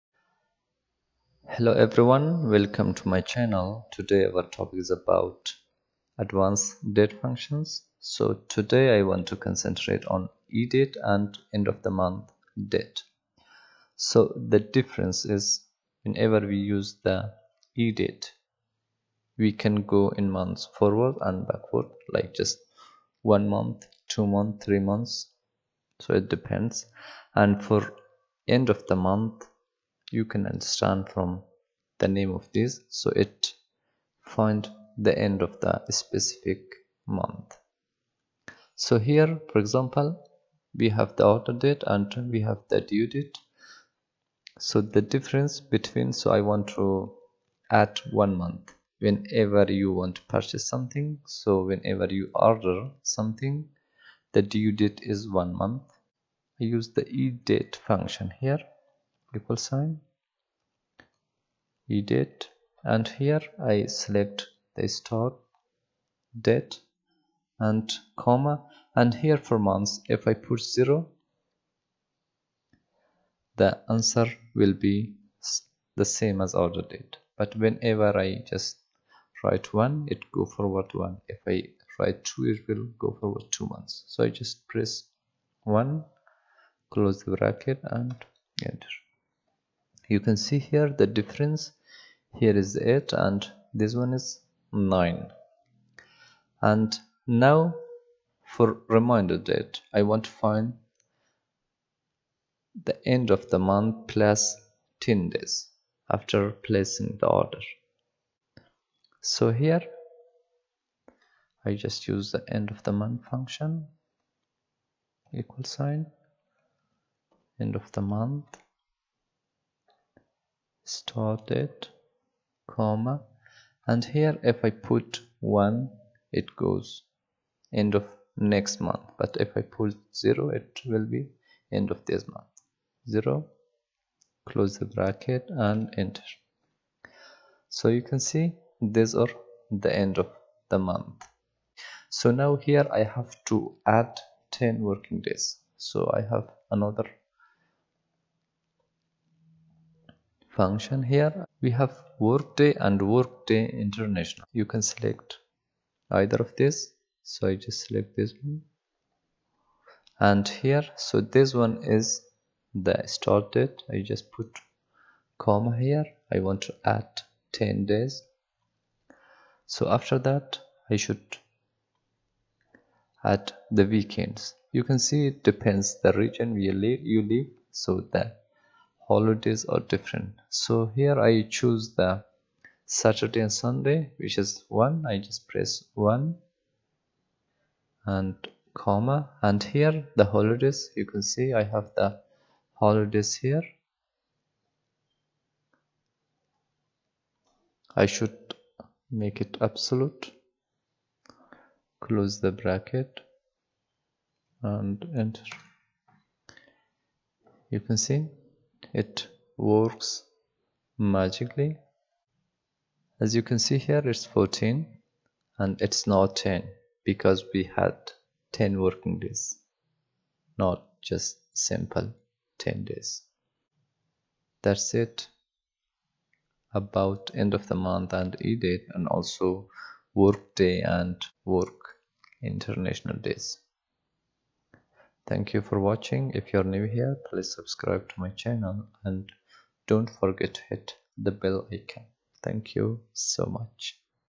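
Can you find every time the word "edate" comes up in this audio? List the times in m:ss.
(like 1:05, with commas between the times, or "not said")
0:10, 0:17, 1:01.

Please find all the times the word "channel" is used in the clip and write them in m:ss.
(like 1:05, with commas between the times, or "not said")
0:03, 3:58.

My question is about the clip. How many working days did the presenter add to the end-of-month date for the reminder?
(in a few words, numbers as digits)
10.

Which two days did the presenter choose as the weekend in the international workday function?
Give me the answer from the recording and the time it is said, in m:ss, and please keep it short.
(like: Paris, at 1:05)
Saturday and Sunday, at 3:02.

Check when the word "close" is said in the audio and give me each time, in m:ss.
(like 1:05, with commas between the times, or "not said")
1:26, 2:14, 3:21.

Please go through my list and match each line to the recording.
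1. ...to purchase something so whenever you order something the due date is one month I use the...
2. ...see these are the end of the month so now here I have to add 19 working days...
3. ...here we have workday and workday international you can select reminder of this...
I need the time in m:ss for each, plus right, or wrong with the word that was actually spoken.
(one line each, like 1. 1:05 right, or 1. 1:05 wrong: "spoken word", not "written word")
1. 0:50 right
2. 2:18 wrong: "10", not "19"
3. 2:31 wrong: "either", not "reminder".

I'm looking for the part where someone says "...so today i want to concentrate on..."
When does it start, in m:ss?
0:07.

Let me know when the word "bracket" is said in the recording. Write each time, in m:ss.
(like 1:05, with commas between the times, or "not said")
1:27, 2:14, 3:22.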